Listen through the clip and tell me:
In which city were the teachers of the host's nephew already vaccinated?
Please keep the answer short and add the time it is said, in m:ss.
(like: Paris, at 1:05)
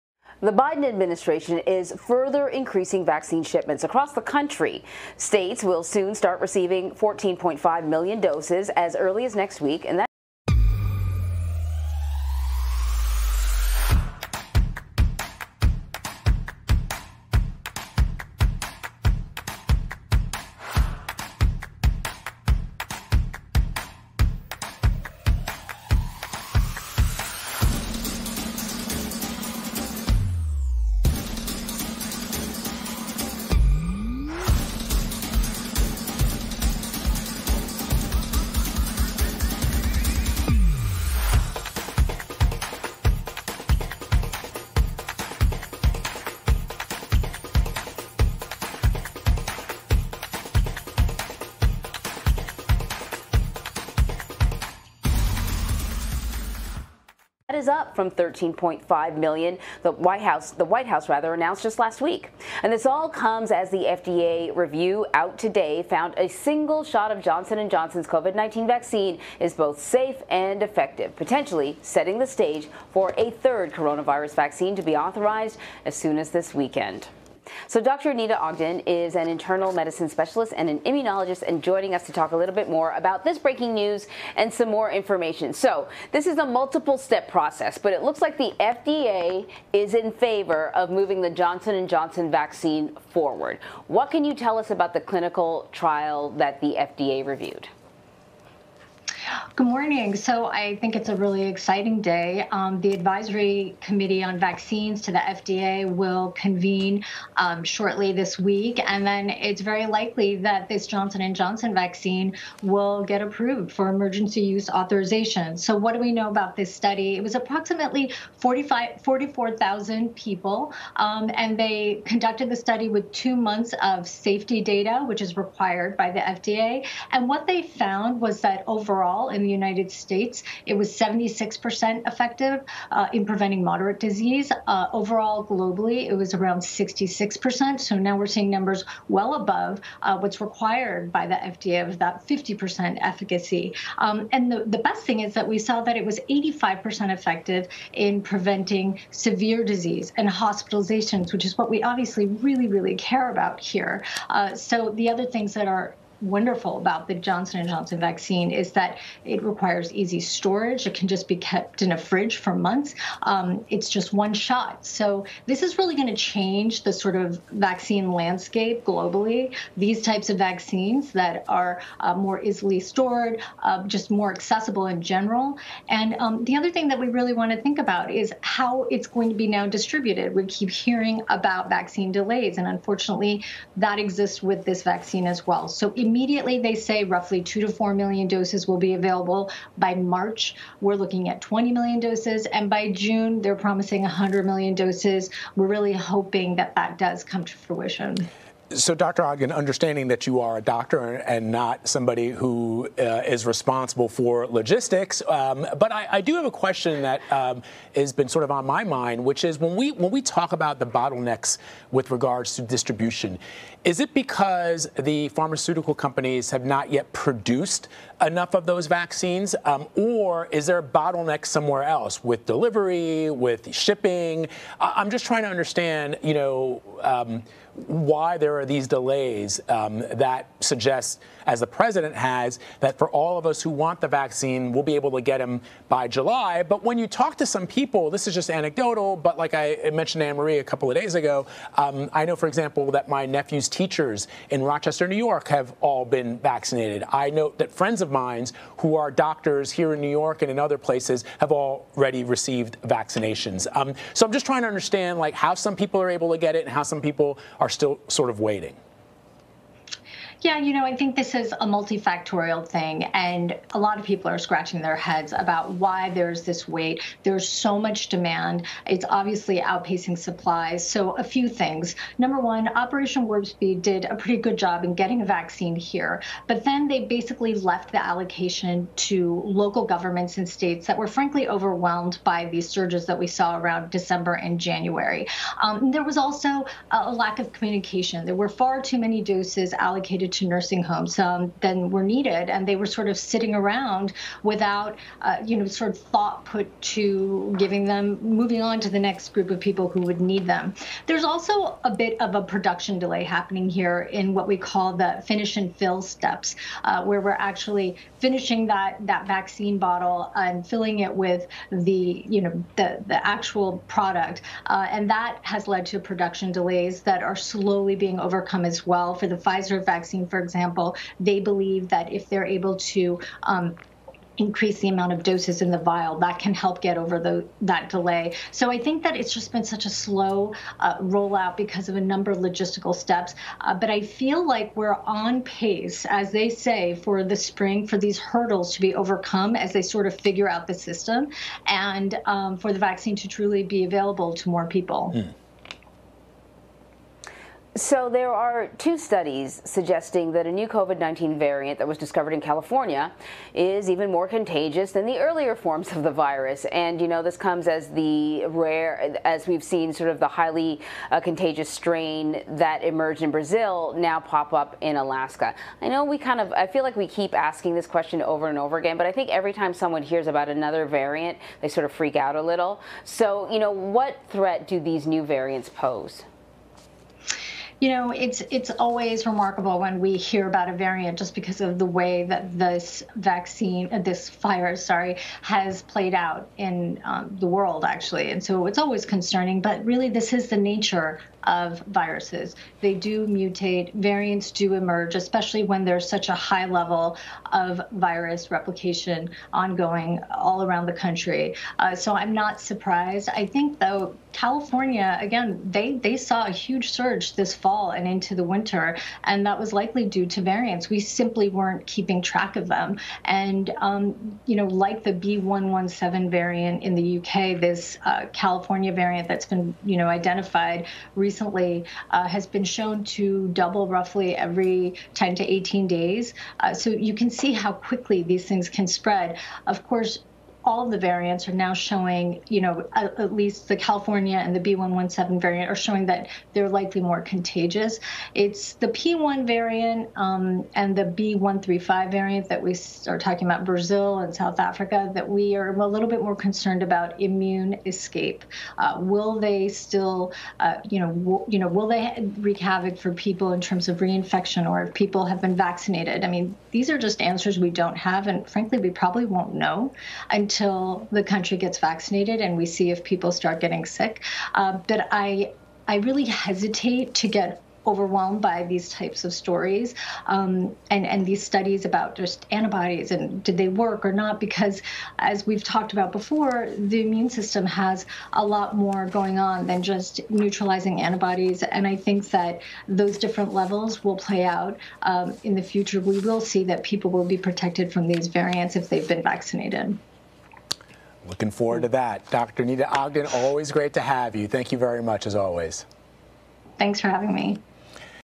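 Rochester, New York, at 4:04.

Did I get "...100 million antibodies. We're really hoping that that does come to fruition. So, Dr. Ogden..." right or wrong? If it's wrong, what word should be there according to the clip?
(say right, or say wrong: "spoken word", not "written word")
wrong: "doses", not "antibodies".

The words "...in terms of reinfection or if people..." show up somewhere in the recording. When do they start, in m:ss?
7:33.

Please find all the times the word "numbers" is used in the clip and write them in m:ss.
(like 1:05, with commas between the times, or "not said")
2:18, 4:32, 5:32.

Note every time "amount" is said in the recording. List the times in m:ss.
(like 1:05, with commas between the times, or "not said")
5:24.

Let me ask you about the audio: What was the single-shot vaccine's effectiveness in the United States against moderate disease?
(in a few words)
76%.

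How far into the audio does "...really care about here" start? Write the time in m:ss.
2:32.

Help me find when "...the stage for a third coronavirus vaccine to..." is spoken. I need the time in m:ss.
1:12.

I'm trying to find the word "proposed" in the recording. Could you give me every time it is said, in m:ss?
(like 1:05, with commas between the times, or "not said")
not said.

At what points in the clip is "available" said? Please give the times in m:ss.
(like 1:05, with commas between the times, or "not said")
3:08, 5:43.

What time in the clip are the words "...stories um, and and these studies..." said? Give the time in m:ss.
7:49.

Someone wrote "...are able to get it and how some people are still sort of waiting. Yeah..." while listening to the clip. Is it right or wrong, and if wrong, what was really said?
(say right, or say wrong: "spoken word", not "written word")
right.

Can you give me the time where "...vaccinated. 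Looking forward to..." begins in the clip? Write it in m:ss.
8:09.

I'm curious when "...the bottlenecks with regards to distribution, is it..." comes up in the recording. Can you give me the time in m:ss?
3:30.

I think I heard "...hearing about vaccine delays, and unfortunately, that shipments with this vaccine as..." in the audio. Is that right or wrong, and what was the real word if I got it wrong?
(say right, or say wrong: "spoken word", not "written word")
wrong: "exists", not "shipments".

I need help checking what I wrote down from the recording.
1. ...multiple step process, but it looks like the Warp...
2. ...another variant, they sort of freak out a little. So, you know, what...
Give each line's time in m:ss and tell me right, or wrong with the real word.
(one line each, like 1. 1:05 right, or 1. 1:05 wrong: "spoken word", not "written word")
1. 1:26 wrong: "FDA", not "Warp"
2. 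6:10 right.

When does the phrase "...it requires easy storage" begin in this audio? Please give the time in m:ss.
2:39.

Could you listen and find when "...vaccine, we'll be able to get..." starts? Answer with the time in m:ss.
3:54.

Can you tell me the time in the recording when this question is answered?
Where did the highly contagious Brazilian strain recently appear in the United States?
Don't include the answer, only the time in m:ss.
6:04.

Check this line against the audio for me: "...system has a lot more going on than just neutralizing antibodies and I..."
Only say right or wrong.
right.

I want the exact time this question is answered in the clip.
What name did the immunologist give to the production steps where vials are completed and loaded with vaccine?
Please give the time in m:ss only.
5:05.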